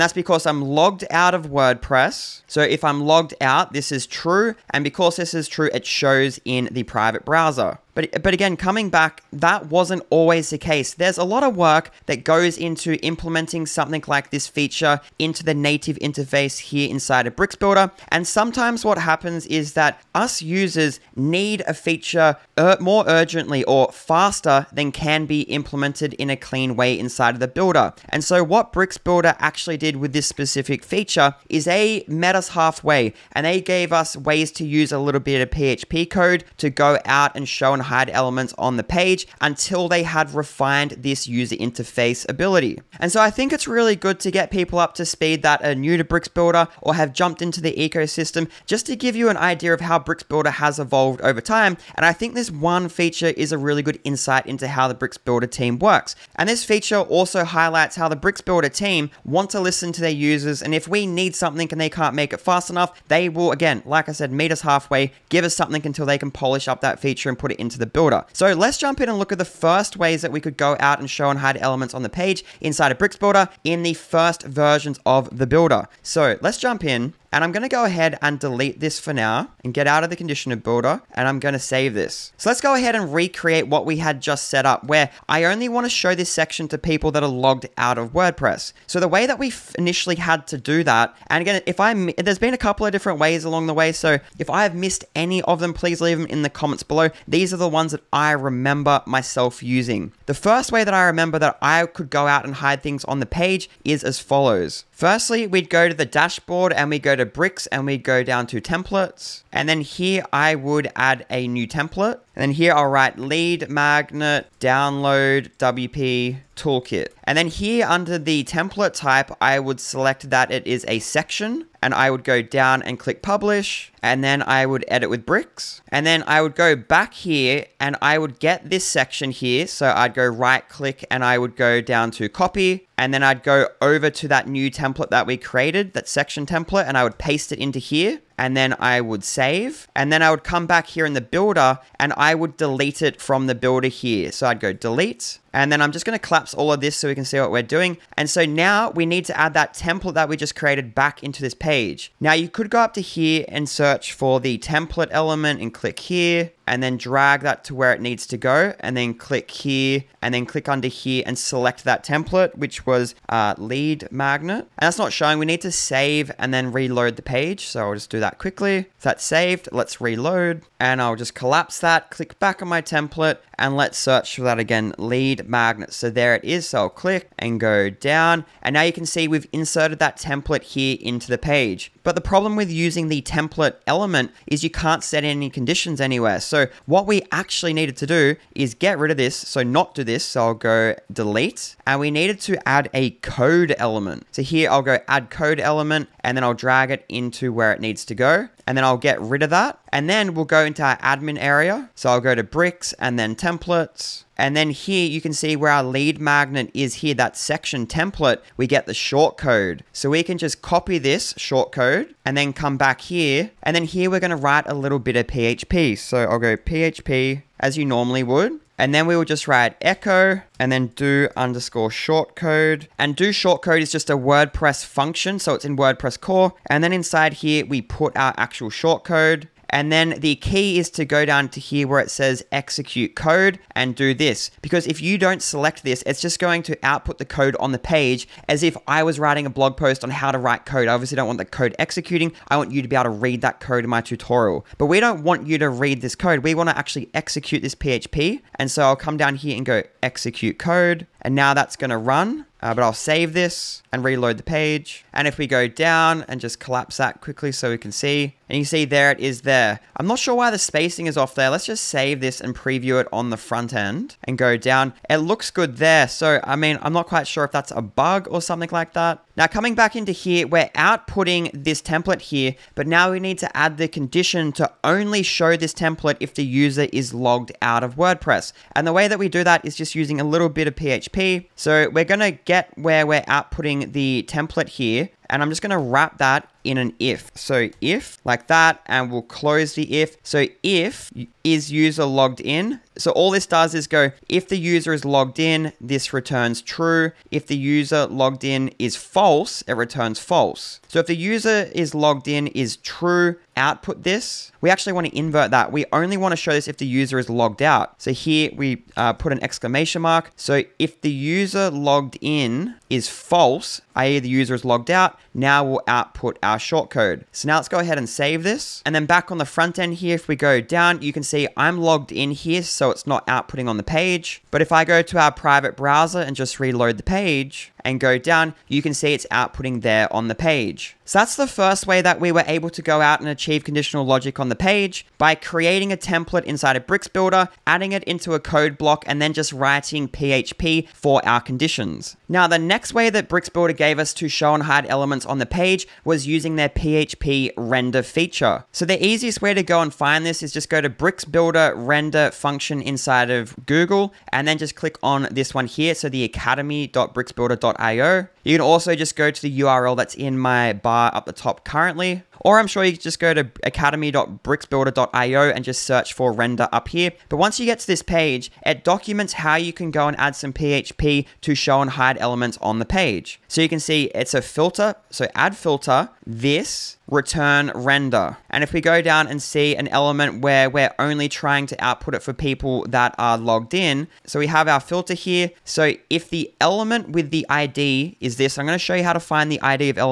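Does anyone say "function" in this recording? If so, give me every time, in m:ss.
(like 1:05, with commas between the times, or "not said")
3:44, 5:52.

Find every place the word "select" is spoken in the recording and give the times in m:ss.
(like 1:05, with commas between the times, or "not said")
1:59, 2:41, 3:55.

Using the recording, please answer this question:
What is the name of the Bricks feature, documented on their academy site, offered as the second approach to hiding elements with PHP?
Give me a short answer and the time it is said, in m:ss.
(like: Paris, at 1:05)
PHP render feature, at 5:46.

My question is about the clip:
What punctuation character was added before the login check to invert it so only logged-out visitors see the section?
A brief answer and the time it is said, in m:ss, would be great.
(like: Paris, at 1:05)
exclamation mark, at 5:09.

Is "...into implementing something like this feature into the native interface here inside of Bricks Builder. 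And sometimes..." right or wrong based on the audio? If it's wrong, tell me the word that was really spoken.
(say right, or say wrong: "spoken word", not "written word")
right.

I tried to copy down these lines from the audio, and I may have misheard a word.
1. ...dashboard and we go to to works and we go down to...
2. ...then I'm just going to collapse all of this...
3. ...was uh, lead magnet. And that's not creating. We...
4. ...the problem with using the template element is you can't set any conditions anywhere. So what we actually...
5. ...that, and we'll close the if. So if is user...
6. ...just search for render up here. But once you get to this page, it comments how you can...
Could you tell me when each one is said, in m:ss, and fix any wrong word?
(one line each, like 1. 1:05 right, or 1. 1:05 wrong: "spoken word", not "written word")
1. 1:46 wrong: "bricks", not "works"
2. 2:25 right
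3. 2:42 wrong: "showing", not "creating"
4. 3:02 right
5. 4:48 right
6. 6:05 wrong: "documents", not "comments".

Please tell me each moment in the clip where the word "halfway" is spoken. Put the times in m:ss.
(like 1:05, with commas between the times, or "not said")
0:32, 1:04.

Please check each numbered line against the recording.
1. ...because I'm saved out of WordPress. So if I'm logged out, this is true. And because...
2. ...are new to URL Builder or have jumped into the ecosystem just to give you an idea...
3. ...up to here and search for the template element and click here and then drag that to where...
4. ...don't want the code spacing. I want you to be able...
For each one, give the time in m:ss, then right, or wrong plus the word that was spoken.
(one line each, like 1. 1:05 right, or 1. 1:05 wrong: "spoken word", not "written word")
1. 0:00 wrong: "logged", not "saved"
2. 0:45 wrong: "Bricks", not "URL"
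3. 2:32 right
4. 4:01 wrong: "executing", not "spacing".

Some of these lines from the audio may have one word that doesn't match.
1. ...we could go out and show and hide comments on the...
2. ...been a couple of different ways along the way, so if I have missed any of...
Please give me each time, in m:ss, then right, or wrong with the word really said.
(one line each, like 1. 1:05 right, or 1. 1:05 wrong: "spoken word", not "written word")
1. 1:10 wrong: "elements", not "comments"
2. 1:32 right.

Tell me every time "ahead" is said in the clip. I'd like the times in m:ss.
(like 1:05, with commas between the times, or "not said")
1:17, 1:22, 5:17.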